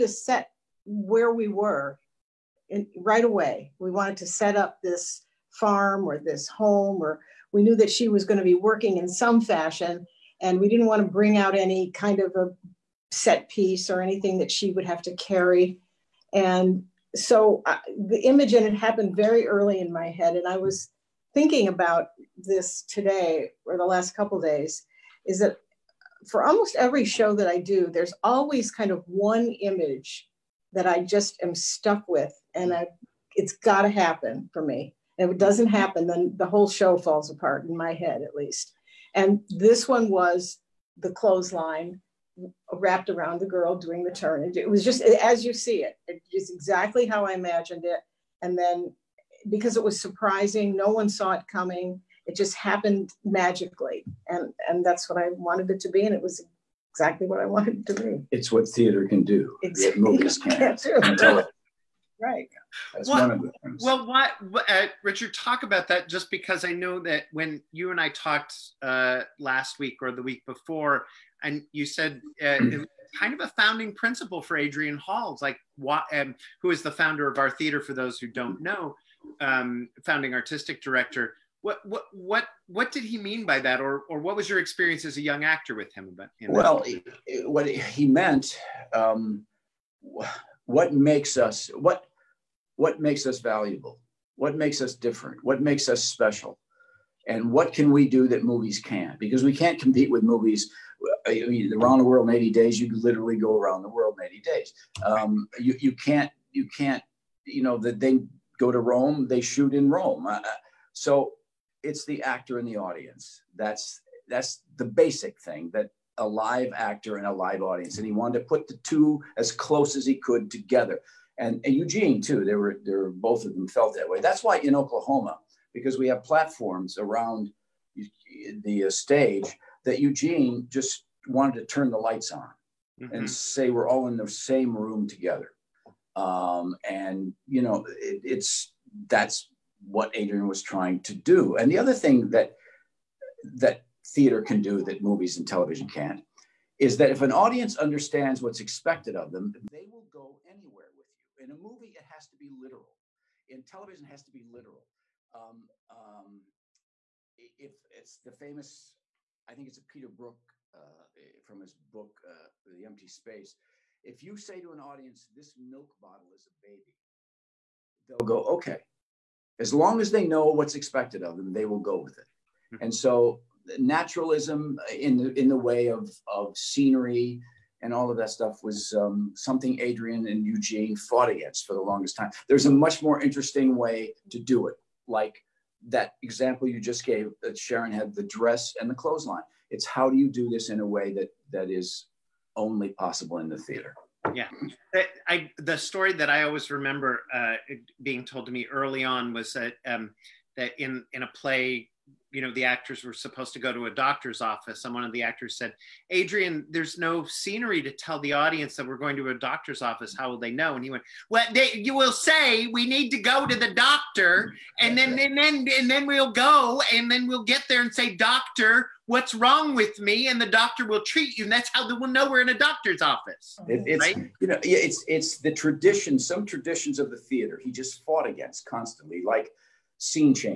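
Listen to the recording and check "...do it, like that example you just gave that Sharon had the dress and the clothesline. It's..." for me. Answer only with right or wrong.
right.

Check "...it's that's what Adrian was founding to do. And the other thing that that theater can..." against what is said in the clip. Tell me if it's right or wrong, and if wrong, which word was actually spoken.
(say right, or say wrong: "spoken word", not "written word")
wrong: "trying", not "founding".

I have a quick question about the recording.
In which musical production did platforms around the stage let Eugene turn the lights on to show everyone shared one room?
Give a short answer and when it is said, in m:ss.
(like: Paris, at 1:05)
Oklahoma, at 2:04.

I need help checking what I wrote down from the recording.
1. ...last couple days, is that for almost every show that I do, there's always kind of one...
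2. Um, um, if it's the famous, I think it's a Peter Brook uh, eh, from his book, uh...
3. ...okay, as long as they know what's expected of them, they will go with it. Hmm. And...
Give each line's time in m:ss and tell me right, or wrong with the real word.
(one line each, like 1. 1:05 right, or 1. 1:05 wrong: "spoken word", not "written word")
1. 0:23 right
2. 2:35 right
3. 2:48 right.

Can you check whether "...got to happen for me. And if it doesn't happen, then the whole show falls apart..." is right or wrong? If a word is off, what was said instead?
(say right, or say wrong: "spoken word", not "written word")
right.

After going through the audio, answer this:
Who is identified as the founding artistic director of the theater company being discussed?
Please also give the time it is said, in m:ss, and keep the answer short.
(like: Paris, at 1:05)
Adrian Hall, at 1:14.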